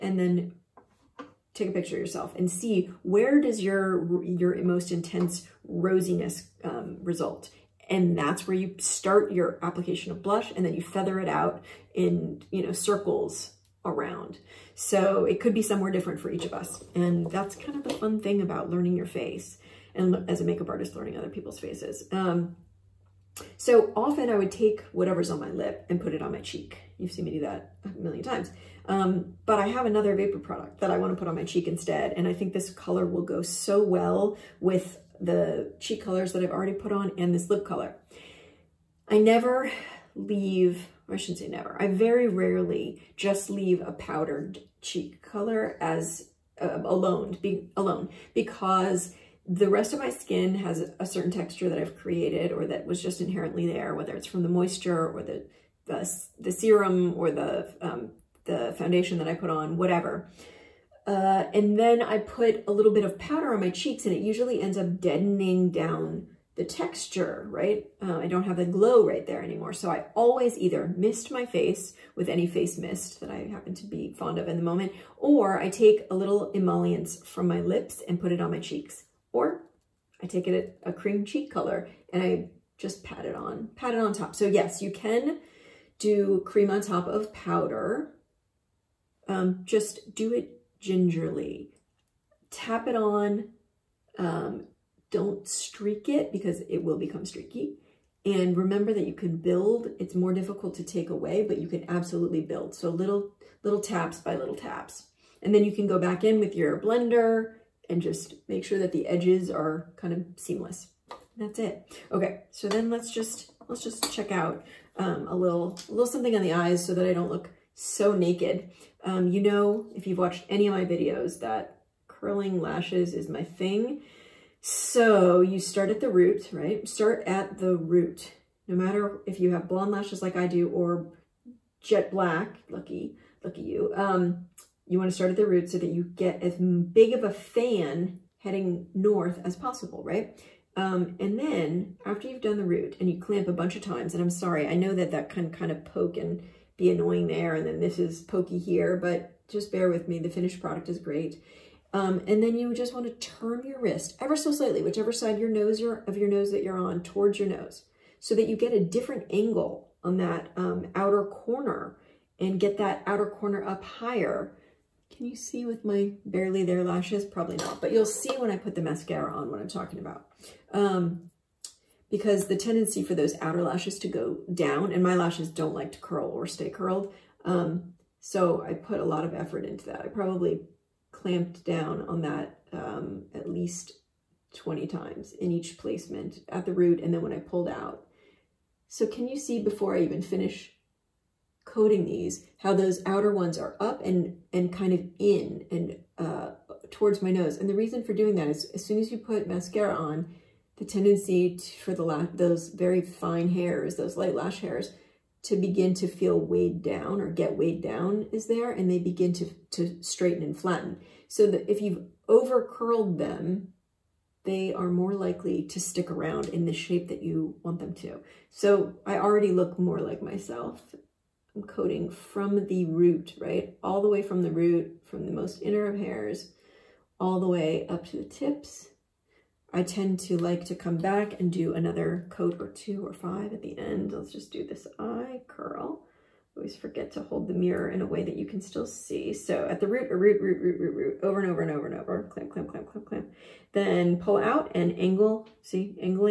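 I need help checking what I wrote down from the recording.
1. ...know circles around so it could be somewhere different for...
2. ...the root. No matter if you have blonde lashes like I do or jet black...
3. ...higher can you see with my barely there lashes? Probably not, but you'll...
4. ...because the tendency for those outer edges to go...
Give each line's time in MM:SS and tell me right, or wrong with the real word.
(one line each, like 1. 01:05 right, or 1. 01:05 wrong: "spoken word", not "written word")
1. 00:12 right
2. 02:07 right
3. 02:43 right
4. 02:52 wrong: "lashes", not "edges".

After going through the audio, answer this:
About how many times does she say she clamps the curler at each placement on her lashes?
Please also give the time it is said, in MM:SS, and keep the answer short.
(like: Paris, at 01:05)
20, at 03:04.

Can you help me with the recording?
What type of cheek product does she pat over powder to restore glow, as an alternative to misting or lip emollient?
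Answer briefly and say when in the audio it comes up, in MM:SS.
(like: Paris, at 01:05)
Cream cheek color, at 01:20.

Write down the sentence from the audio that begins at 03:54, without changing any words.
Let's just do this eye curl.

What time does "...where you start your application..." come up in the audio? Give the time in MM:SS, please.
00:08.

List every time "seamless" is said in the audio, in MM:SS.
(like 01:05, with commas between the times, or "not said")
01:50.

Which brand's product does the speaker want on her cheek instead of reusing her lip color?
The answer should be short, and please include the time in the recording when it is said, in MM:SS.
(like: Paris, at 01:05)
Vapour, at 00:30.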